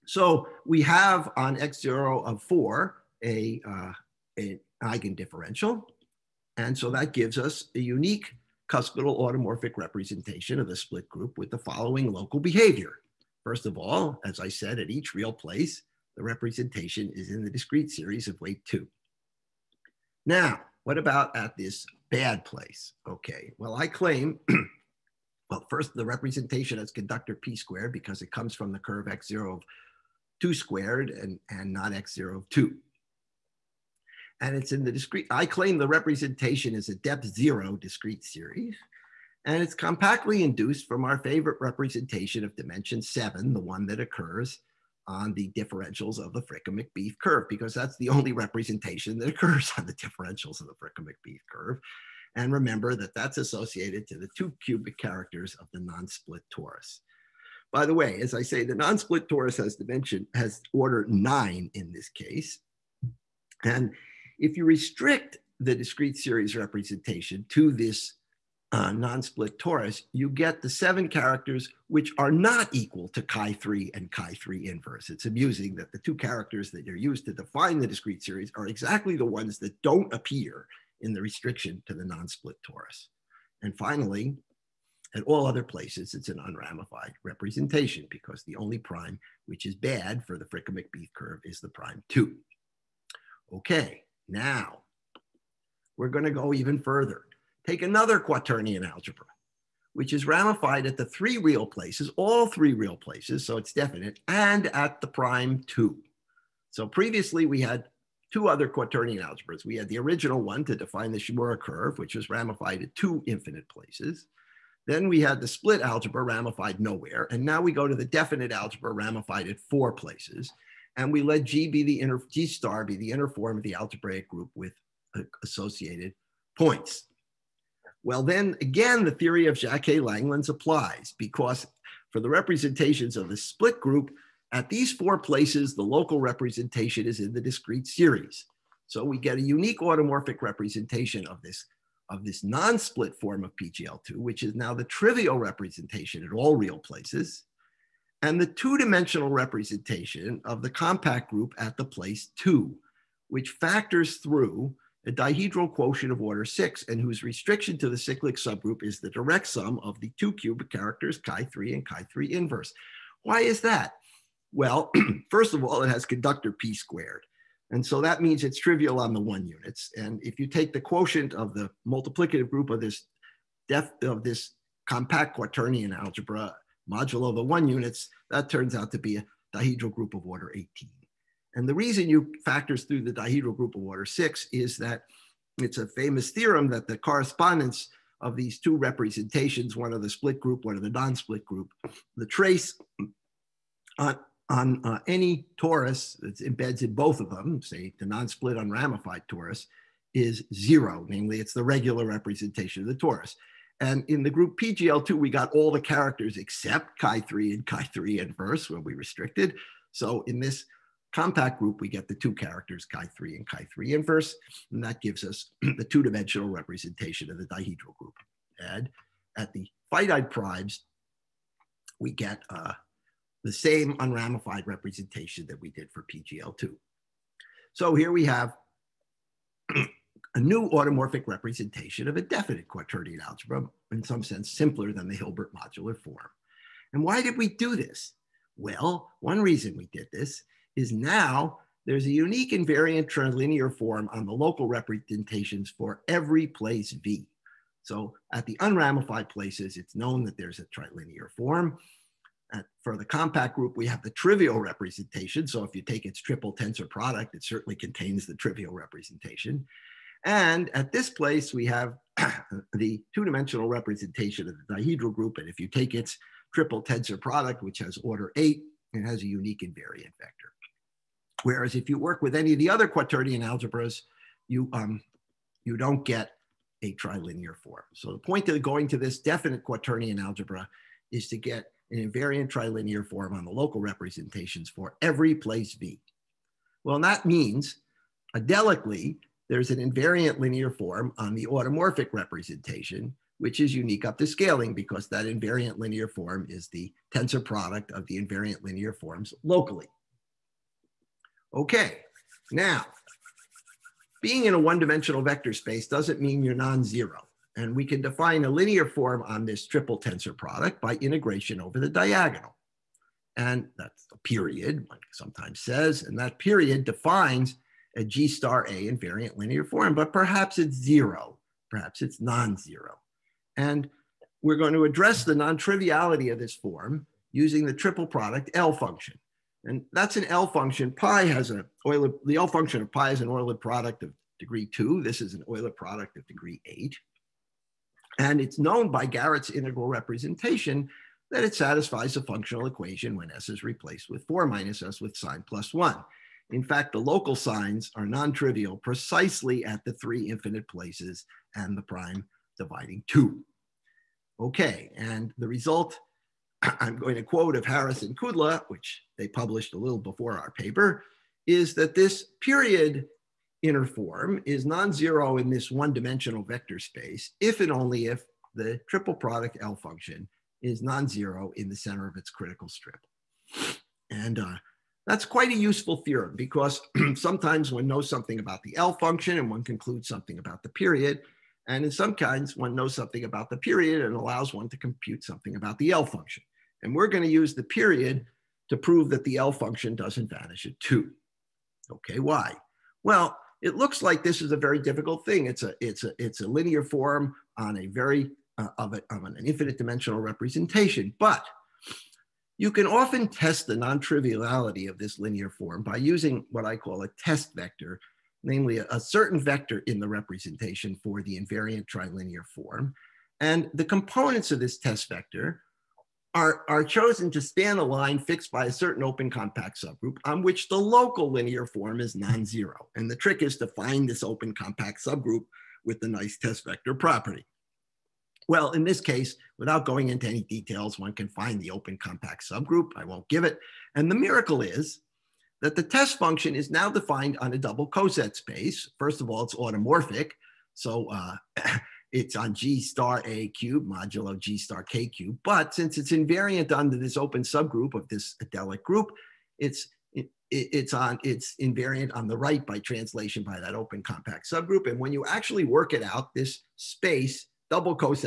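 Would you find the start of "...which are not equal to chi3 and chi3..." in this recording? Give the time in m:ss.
1:11.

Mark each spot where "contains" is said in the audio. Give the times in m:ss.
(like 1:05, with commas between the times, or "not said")
4:17.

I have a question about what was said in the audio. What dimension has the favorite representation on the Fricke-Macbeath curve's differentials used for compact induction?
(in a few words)
7.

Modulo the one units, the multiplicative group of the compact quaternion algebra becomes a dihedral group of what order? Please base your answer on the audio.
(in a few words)
18.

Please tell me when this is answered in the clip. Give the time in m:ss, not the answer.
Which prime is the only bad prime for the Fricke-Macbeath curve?
1:31.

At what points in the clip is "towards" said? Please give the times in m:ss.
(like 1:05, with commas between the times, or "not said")
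not said.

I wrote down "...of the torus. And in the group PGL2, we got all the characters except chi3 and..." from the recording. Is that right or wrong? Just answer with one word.
right.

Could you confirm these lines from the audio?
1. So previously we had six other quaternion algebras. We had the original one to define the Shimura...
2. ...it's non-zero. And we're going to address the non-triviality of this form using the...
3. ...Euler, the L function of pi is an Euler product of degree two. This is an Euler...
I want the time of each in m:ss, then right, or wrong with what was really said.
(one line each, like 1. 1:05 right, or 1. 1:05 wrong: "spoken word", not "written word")
1. 1:46 wrong: "two", not "six"
2. 5:22 right
3. 5:31 right.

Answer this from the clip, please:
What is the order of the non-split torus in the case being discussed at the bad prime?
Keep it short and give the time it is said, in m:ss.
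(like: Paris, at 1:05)
9, at 1:00.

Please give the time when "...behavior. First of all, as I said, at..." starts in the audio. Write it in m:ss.
0:12.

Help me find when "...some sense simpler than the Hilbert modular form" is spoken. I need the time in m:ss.
3:54.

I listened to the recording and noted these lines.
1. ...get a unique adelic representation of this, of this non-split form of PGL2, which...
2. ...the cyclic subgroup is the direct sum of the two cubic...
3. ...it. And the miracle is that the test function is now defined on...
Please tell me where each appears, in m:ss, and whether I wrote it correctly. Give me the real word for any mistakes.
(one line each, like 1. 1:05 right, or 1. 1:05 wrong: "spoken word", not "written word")
1. 2:19 wrong: "automorphic", not "adelic"
2. 2:37 right
3. 7:13 right.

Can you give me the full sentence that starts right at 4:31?
Whereas if you work with any of the other quaternion algebras, you, um, you don't get a trilinear form.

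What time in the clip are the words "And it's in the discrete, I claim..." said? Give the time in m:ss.
0:34.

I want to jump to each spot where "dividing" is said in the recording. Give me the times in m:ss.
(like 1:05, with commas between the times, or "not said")
5:52.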